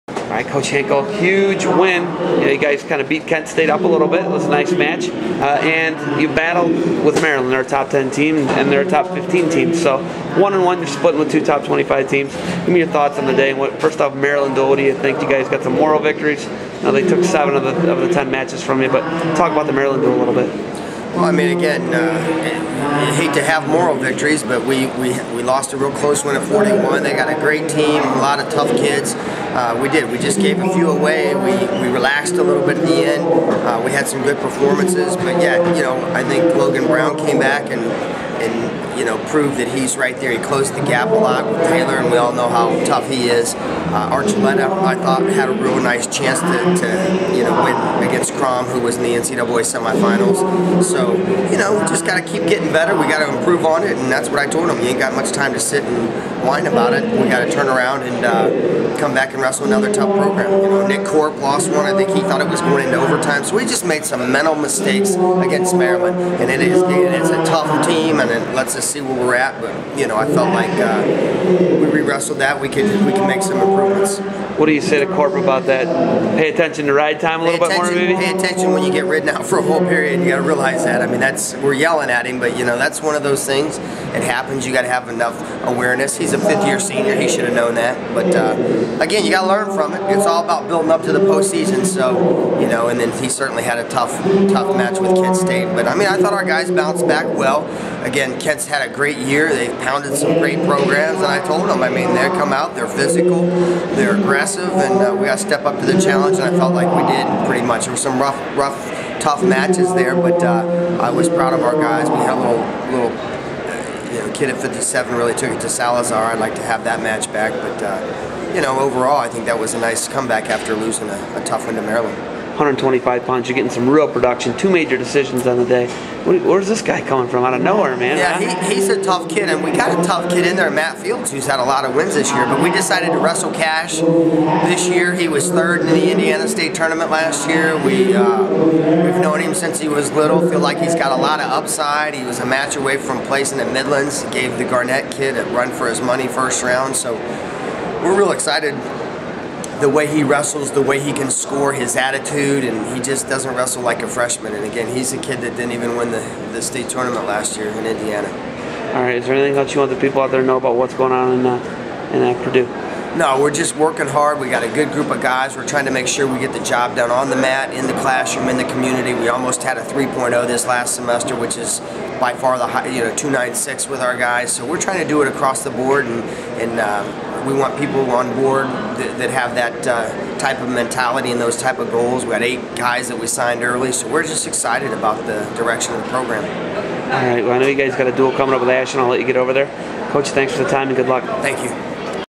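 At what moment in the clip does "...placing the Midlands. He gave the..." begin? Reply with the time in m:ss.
2:23.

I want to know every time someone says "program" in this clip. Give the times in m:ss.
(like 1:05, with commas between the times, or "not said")
1:00, 1:40, 3:06.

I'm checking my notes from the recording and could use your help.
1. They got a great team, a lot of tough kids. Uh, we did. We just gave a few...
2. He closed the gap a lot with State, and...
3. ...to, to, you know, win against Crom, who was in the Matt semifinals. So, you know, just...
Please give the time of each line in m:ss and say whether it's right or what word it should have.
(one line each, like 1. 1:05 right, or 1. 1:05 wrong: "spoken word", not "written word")
1. 0:27 right
2. 0:40 wrong: "Taylor", not "State"
3. 0:46 wrong: "NCAA", not "Matt".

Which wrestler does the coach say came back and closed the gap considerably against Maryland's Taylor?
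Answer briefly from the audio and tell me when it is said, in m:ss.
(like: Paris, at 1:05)
Logan Brown, at 0:36.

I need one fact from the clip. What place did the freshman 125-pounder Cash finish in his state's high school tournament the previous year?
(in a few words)
third.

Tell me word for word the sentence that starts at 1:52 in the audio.
We had a little, little uh, you know, kid at 57 really took it to Salazar.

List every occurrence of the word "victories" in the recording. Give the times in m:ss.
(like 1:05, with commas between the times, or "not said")
0:15, 0:23.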